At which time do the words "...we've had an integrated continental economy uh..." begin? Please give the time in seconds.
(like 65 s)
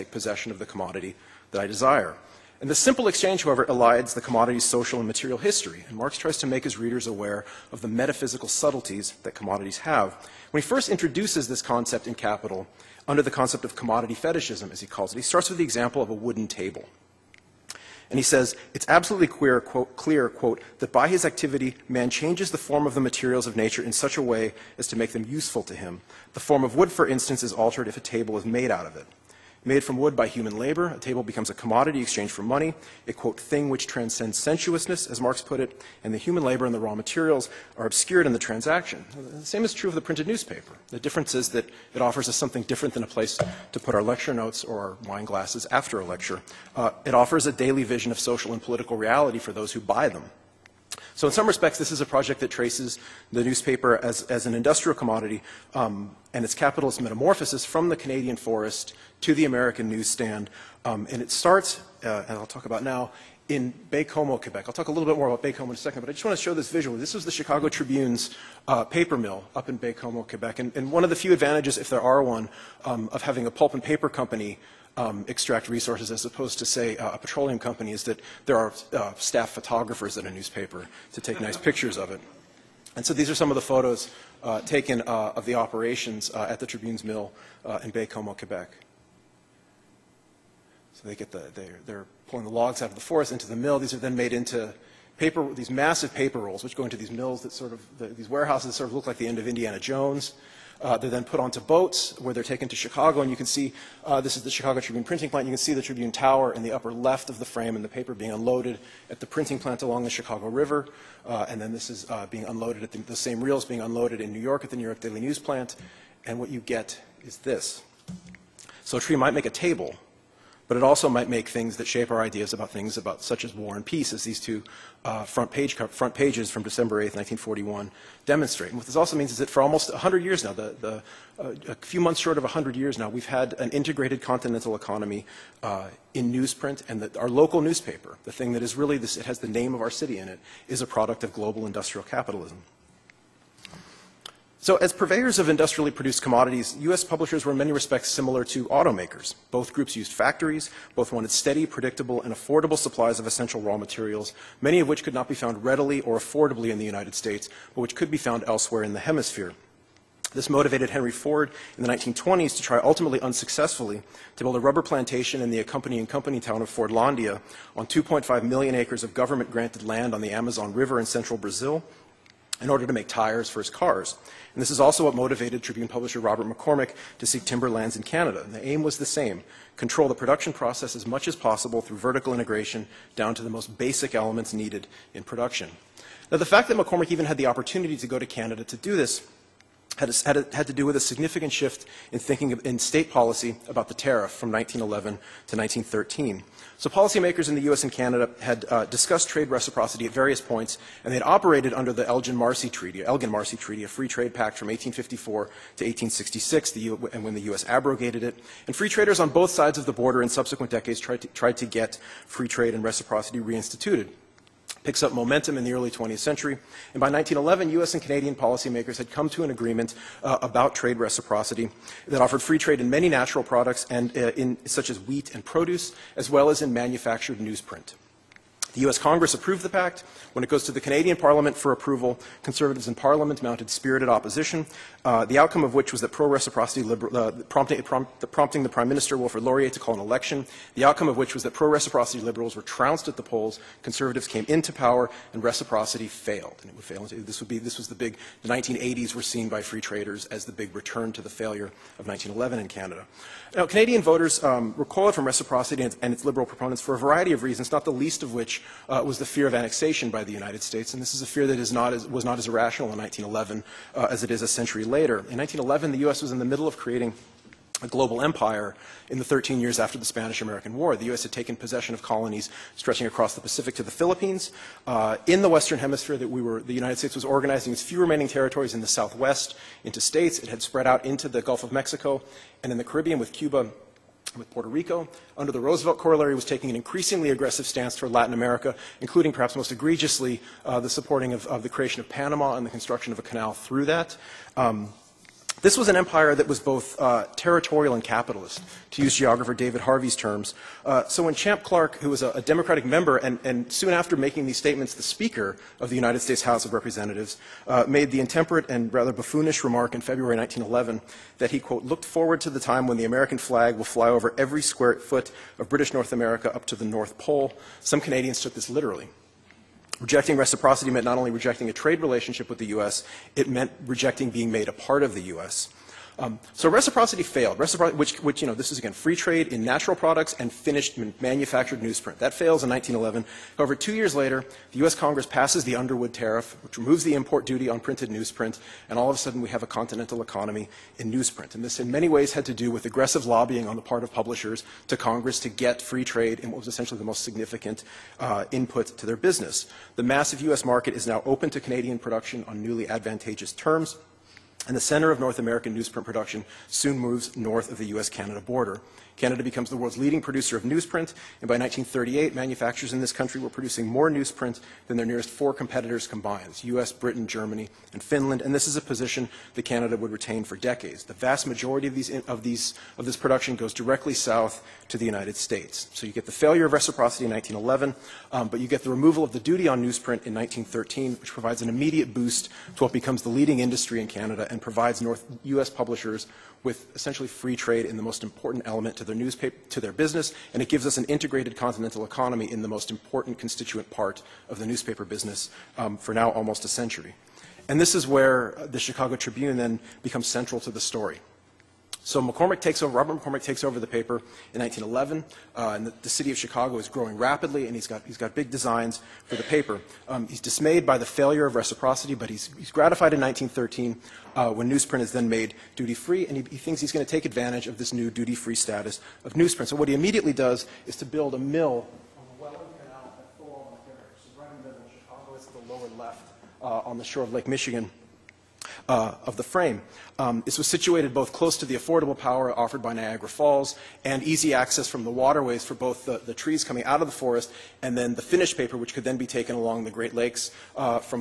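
133 s.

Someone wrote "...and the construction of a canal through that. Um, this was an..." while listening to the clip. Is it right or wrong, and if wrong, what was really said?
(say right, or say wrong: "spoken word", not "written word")
right.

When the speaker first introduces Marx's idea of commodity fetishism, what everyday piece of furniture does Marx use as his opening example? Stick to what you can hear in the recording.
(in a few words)
A wooden table.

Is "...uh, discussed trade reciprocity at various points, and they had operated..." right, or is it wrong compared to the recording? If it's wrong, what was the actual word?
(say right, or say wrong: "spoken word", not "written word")
right.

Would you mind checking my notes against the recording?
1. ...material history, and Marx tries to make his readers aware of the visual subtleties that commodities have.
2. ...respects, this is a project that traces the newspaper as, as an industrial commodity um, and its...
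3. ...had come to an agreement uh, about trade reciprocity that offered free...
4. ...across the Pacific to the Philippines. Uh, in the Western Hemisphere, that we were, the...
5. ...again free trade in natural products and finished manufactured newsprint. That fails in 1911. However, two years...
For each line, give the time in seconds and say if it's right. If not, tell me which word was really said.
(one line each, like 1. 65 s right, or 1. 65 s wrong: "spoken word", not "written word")
1. 5 s wrong: "metaphysical", not "visual"
2. 51 s right
3. 218 s right
4. 273 s right
5. 328 s right.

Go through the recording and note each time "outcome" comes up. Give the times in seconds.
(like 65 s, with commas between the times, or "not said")
235 s, 240 s.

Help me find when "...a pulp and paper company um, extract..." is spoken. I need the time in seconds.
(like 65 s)
73 s.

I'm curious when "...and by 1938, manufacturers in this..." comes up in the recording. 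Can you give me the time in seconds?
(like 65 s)
361 s.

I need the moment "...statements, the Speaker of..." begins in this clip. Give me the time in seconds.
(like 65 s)
304 s.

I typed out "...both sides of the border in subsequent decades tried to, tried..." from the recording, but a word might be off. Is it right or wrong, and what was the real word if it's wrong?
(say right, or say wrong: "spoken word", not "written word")
right.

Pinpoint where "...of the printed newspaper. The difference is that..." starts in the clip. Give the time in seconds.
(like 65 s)
39 s.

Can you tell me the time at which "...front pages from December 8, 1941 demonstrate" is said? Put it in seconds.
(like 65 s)
125 s.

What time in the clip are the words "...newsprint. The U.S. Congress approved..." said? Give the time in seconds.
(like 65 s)
227 s.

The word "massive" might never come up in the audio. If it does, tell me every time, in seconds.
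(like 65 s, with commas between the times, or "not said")
95 s, 350 s.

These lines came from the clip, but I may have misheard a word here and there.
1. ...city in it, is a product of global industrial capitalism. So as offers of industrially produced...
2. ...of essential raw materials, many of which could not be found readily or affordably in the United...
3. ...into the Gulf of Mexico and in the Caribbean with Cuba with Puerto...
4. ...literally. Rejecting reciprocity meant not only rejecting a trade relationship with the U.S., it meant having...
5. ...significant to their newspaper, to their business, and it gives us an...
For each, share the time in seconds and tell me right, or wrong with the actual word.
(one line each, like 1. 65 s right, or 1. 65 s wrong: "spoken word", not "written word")
1. 139 s wrong: "purveyors", not "offers"
2. 153 s right
3. 281 s right
4. 318 s wrong: "rejecting", not "having"
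5. 388 s wrong: "element", not "significant".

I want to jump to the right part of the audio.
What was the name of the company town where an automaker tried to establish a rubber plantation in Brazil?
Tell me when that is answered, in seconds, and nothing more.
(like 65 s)
166 s.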